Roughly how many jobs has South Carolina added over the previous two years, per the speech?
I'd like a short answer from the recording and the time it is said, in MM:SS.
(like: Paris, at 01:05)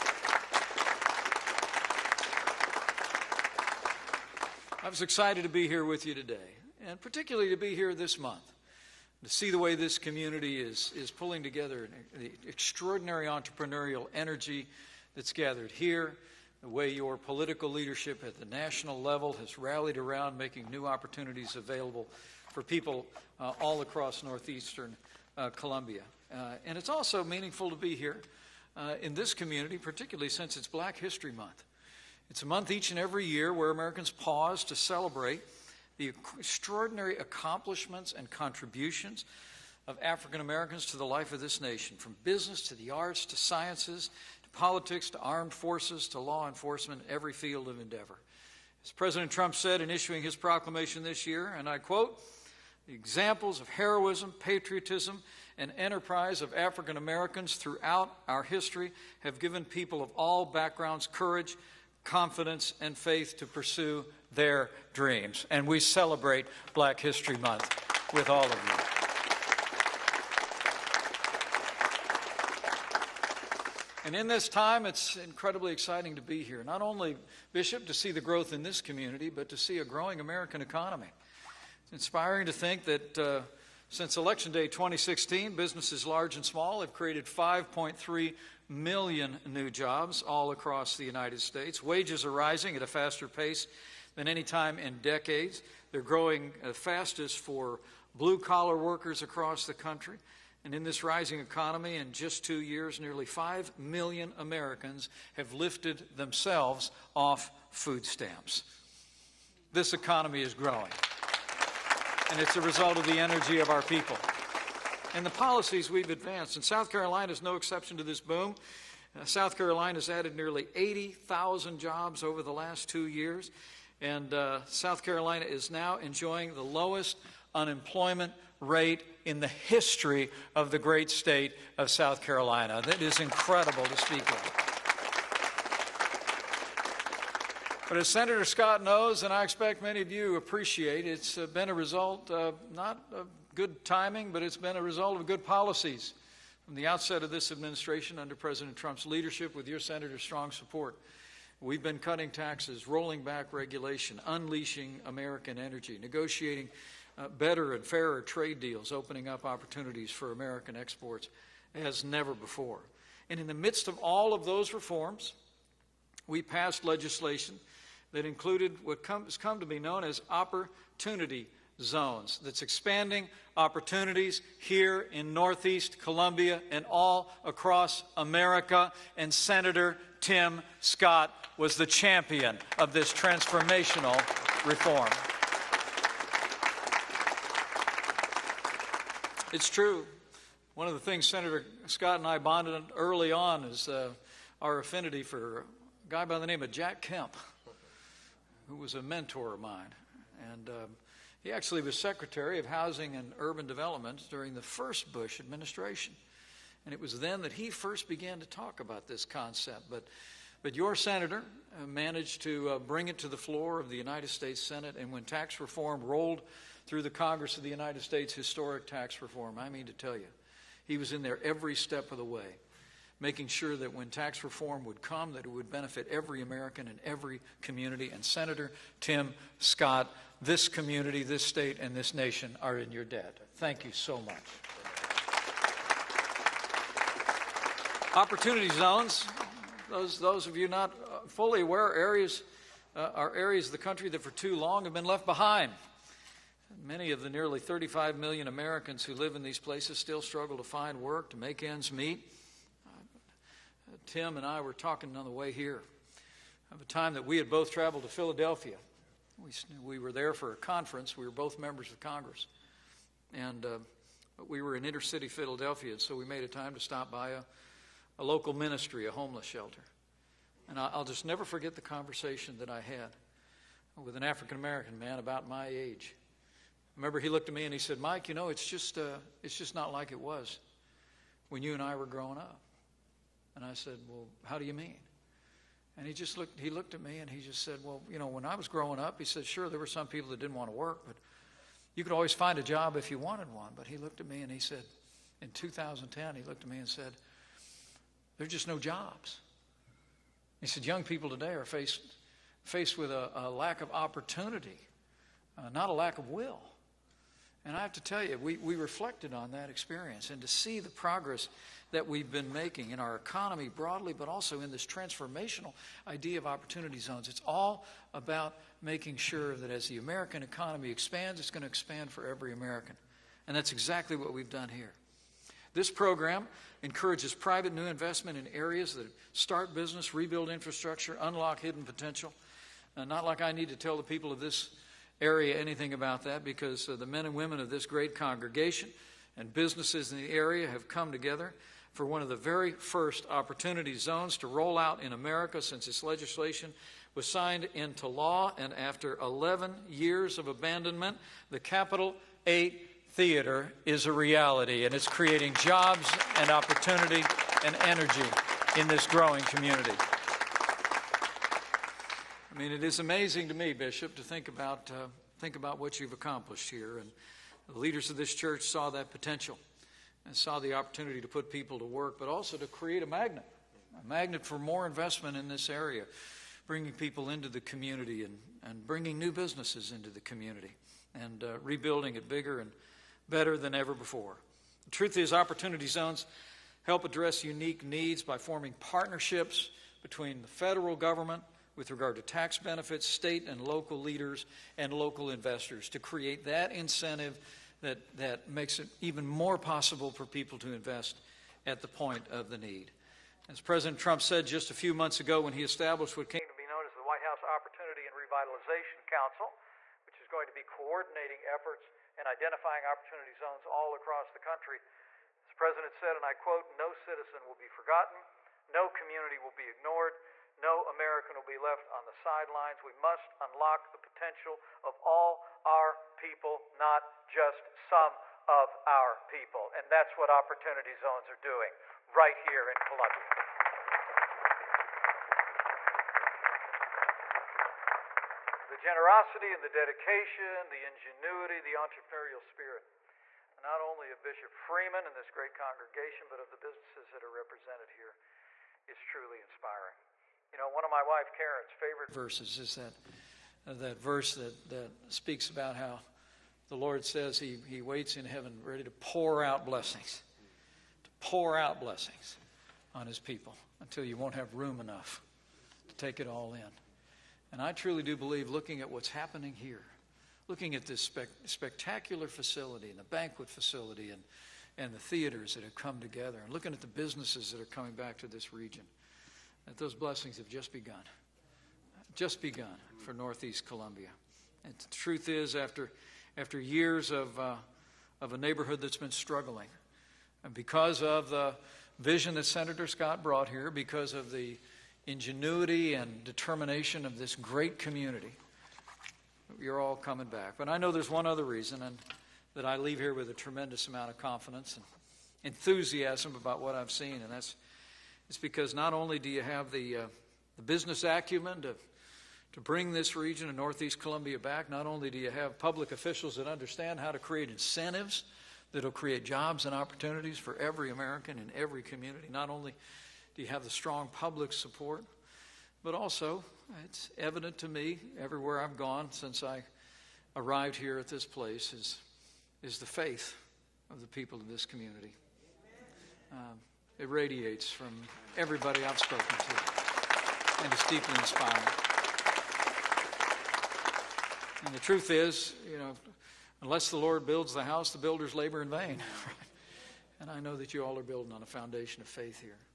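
80,000, at 02:00.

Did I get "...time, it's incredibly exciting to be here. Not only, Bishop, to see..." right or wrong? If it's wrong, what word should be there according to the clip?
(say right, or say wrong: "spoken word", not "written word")
right.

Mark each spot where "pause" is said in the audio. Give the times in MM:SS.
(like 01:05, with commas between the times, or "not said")
00:34.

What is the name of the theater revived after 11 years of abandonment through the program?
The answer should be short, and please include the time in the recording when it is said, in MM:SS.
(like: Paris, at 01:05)
Capital 8, at 05:51.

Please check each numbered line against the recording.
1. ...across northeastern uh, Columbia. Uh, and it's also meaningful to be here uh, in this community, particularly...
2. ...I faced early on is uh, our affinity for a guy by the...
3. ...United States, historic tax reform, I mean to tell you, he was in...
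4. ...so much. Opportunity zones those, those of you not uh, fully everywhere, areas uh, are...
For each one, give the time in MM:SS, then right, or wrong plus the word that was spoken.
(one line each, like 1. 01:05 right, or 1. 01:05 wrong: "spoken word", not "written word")
1. 00:23 right
2. 03:12 wrong: "bonded", not "faced"
3. 03:37 right
4. 03:53 wrong: "aware", not "everywhere".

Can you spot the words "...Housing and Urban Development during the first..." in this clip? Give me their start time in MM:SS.
03:22.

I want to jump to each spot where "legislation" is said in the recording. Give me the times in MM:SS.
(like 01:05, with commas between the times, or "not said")
02:46, 05:46.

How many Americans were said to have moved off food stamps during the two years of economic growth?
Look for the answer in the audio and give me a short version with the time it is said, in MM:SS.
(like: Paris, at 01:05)
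nearly 5 million, at 01:42.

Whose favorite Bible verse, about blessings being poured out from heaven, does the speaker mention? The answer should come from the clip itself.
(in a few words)
Karen.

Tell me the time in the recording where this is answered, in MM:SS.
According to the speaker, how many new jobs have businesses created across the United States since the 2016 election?
01:27.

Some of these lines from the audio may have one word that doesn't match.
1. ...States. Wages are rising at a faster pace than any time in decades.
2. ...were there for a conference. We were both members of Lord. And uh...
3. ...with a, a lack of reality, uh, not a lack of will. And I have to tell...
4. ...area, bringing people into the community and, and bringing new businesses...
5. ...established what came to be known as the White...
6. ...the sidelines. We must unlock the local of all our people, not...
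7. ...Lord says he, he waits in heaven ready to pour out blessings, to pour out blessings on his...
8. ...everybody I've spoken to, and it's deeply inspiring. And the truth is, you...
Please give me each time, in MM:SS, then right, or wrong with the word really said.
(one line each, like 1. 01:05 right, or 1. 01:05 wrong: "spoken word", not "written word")
1. 01:31 right
2. 04:19 wrong: "Congress", not "Lord"
3. 05:02 wrong: "opportunity", not "reality"
4. 06:15 right
5. 06:45 right
6. 07:02 wrong: "potential", not "local"
7. 07:36 right
8. 08:58 right.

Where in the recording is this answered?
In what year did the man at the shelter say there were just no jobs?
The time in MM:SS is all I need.
04:55.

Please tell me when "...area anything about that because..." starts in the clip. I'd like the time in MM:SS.
05:35.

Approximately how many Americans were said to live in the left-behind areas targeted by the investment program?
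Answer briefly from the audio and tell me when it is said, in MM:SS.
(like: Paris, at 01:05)
nearly 35 million, at 04:07.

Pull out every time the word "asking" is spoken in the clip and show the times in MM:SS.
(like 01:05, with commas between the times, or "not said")
not said.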